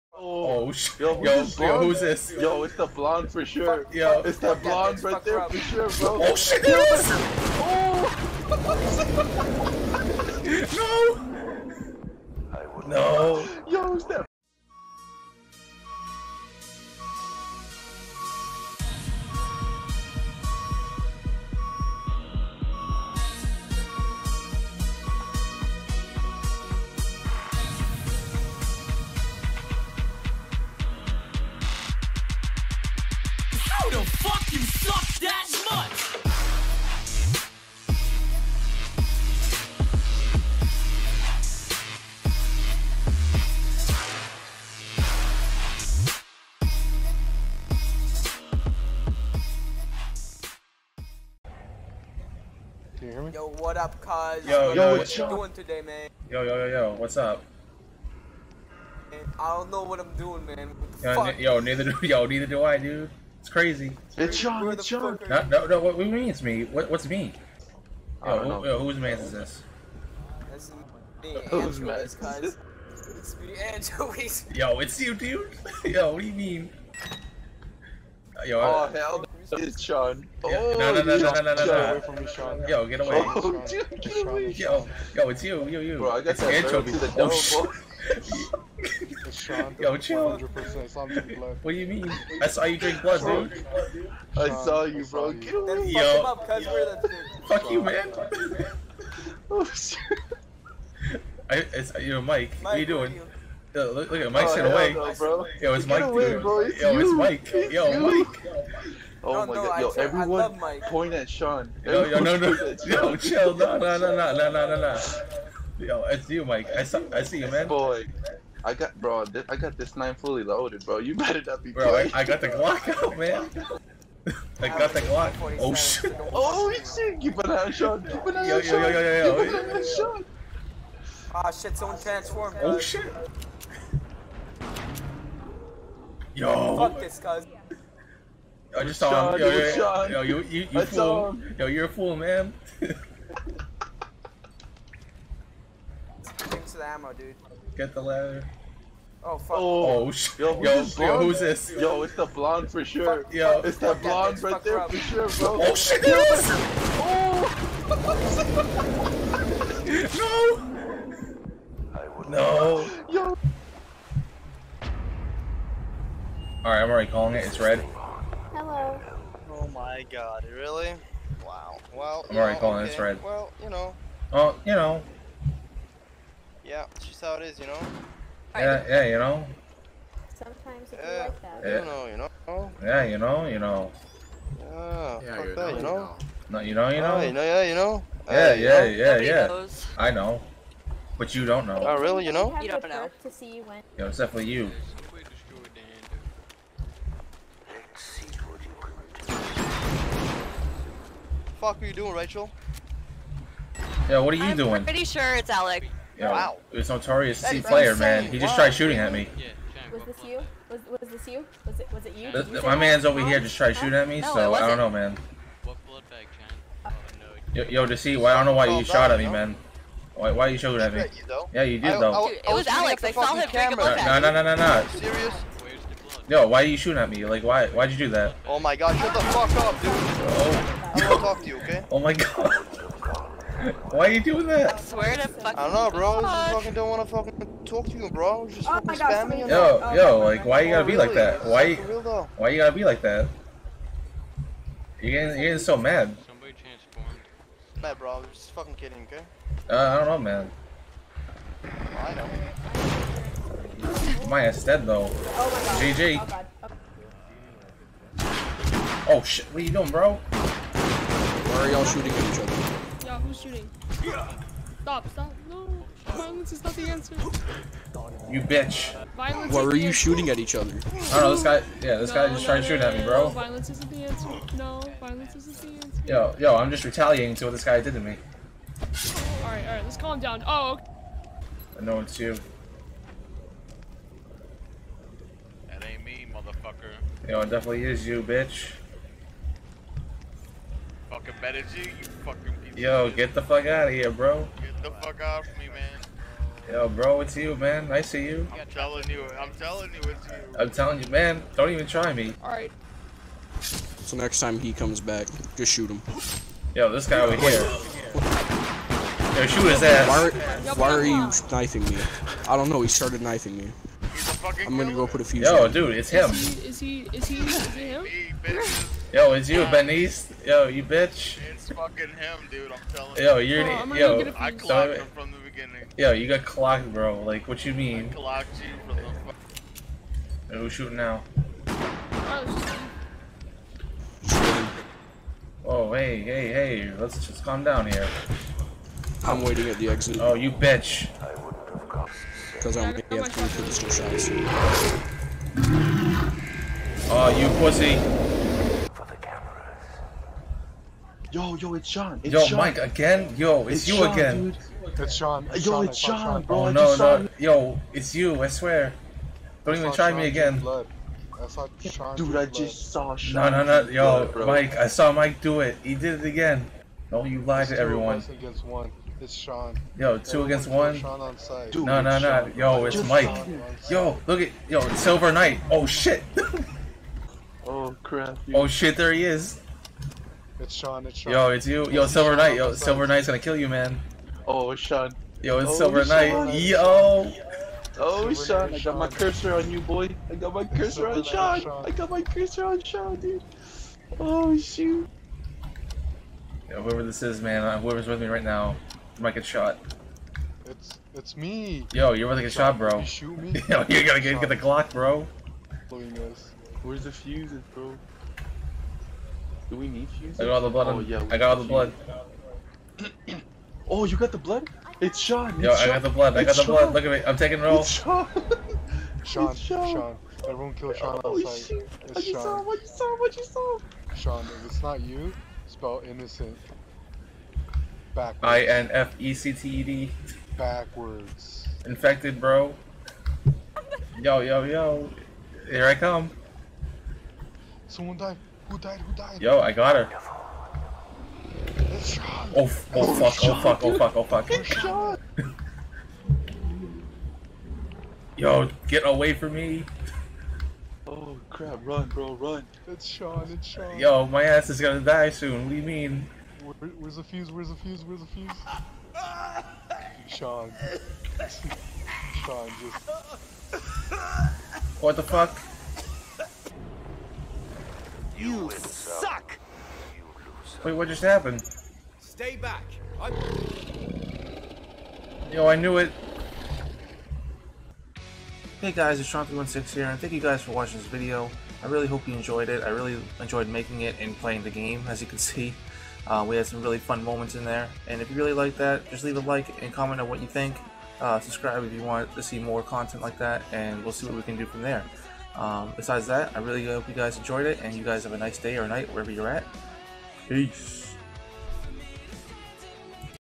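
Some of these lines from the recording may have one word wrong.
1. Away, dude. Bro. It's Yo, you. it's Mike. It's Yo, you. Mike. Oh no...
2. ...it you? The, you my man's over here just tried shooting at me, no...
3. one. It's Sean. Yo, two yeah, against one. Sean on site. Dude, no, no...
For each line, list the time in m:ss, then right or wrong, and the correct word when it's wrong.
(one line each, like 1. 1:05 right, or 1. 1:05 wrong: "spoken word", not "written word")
1. 1:46 right
2. 3:32 right
3. 6:08 right.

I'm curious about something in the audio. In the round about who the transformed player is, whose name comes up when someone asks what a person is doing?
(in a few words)
Rachel.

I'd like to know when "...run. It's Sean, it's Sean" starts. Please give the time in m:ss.
7:32.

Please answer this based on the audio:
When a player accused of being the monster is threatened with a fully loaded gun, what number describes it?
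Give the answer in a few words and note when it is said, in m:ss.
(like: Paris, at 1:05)
9, at 1:59.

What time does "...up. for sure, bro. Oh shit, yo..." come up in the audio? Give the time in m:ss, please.
2:34.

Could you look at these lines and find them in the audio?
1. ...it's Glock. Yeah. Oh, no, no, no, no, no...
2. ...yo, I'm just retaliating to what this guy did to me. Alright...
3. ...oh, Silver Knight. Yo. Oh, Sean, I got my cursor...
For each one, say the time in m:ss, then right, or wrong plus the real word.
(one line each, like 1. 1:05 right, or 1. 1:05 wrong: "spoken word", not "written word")
1. 1:19 wrong: "Sean", not "Glock"
2. 4:36 right
3. 6:25 right.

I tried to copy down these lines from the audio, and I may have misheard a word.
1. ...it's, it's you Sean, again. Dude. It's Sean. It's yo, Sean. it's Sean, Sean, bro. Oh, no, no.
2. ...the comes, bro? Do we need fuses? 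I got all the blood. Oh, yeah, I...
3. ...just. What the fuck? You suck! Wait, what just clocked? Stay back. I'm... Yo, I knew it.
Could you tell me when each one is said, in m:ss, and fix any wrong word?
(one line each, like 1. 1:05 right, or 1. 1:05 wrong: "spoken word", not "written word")
1. 5:53 right
2. 6:47 wrong: "fuses", not "comes"
3. 7:42 wrong: "happened", not "clocked".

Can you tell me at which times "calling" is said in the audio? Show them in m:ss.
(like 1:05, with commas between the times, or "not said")
2:47, 2:52.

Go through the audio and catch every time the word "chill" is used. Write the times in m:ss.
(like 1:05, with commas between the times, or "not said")
1:29, 1:53.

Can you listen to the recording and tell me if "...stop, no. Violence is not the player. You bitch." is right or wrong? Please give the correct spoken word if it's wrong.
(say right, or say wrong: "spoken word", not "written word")
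wrong: "answer", not "player".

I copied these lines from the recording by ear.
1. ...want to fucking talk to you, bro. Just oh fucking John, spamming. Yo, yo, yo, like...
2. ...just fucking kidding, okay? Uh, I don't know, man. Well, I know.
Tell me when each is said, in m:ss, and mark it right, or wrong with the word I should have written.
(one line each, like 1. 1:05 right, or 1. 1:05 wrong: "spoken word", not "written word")
1. 3:56 wrong: "God", not "John"
2. 4:08 right.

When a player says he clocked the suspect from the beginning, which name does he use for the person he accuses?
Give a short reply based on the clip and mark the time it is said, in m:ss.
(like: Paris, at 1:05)
Benise, at 5:19.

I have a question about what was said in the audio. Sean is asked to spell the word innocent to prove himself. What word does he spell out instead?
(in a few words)
Infected.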